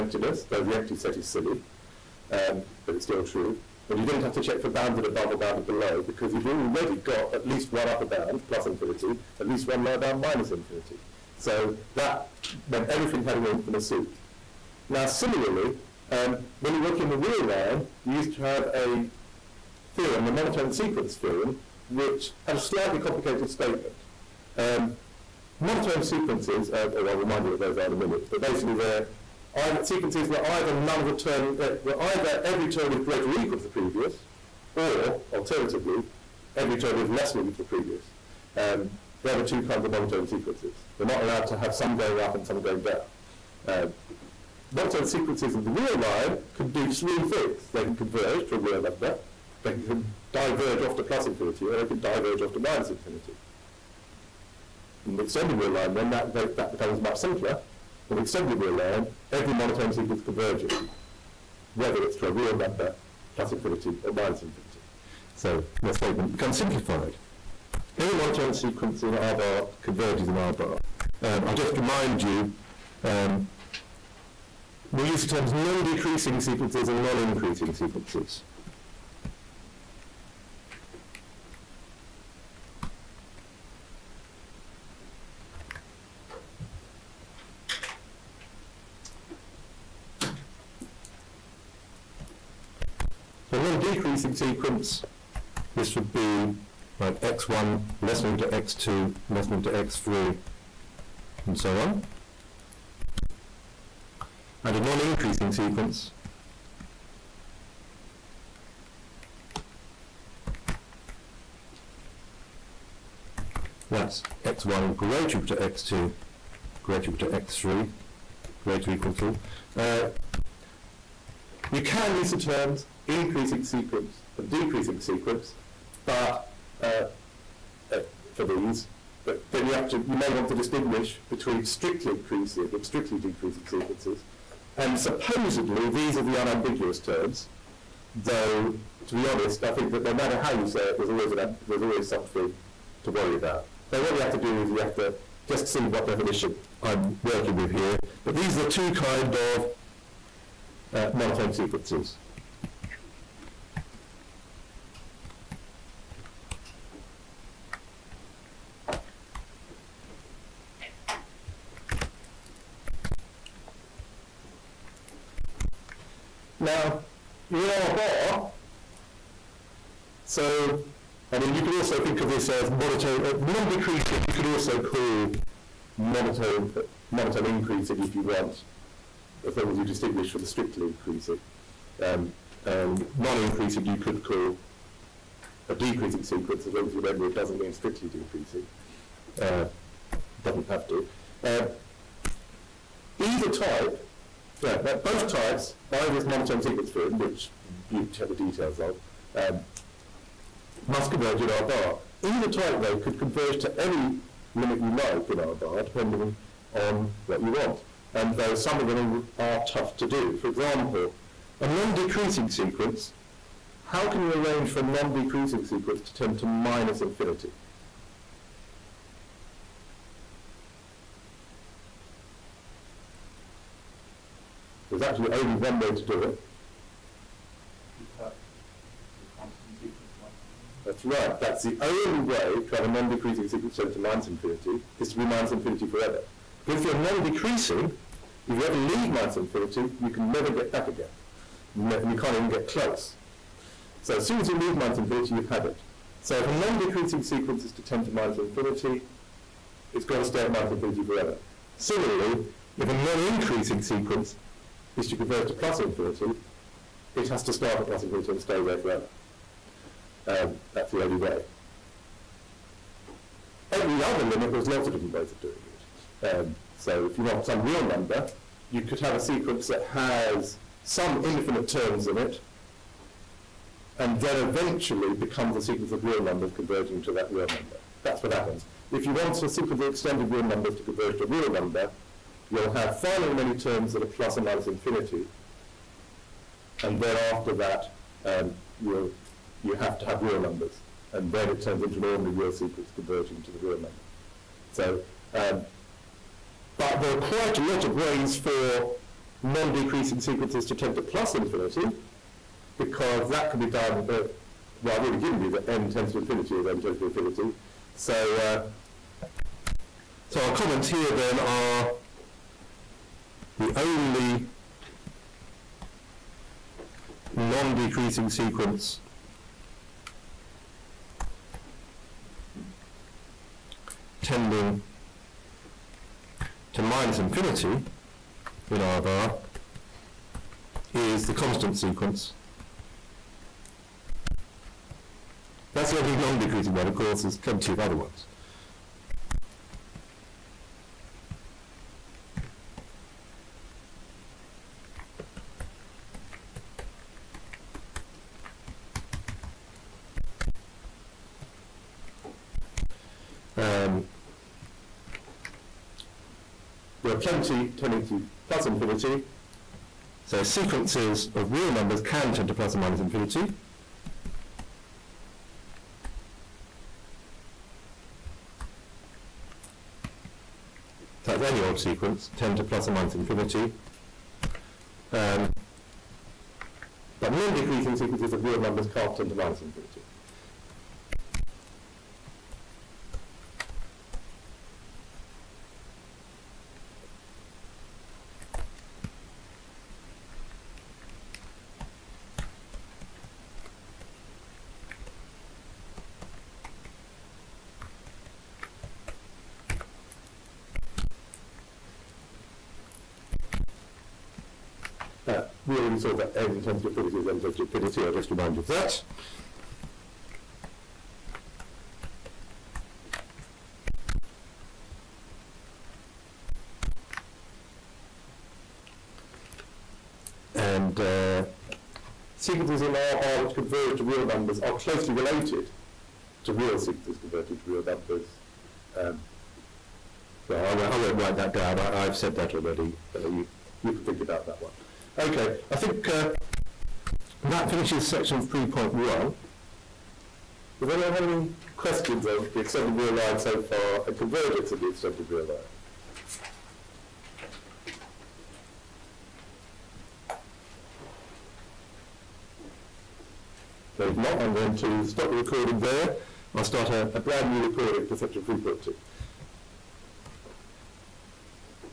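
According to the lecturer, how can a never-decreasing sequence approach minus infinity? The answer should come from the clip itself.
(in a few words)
be minus infinity forever.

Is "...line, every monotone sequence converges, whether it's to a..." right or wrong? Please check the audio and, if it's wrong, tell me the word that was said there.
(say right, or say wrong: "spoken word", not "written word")
right.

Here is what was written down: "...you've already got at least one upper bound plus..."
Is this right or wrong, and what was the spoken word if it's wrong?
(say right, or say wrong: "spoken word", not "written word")
right.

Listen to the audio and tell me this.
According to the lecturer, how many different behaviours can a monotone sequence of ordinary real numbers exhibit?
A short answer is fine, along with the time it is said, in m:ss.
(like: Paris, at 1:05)
3, at 0:46.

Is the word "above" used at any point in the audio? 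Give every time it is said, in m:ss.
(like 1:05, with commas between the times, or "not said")
0:05.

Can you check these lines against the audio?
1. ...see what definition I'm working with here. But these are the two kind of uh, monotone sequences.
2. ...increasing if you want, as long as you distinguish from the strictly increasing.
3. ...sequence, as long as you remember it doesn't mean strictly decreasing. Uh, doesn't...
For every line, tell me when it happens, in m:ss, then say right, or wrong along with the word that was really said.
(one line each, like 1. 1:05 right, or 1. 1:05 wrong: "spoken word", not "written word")
1. 2:25 right
2. 2:57 right
3. 3:06 right.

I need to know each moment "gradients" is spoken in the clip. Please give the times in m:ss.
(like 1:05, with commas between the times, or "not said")
not said.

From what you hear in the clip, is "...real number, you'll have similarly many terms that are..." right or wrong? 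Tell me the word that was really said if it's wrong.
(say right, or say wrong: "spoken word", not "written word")
wrong: "finally", not "similarly".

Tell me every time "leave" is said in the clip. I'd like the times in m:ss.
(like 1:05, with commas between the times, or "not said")
3:58, 4:04.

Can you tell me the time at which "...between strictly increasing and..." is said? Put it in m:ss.
2:11.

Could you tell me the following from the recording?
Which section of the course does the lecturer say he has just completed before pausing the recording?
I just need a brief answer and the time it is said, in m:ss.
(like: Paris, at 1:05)
3.1, at 7:18.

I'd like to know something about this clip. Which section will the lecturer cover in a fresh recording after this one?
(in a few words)
3.2.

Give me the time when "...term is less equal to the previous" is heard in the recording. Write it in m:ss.
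0:36.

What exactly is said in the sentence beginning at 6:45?
You already saw that n tends to infinity is n infinity.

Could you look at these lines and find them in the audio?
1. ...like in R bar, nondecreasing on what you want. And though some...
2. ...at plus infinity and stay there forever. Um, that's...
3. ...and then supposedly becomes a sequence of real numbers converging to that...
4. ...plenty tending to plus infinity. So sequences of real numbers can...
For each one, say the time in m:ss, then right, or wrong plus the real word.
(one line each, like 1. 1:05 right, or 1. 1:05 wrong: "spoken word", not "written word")
1. 3:24 wrong: "depending", not "nondecreasing"
2. 4:17 right
3. 4:33 wrong: "eventually", not "supposedly"
4. 5:57 right.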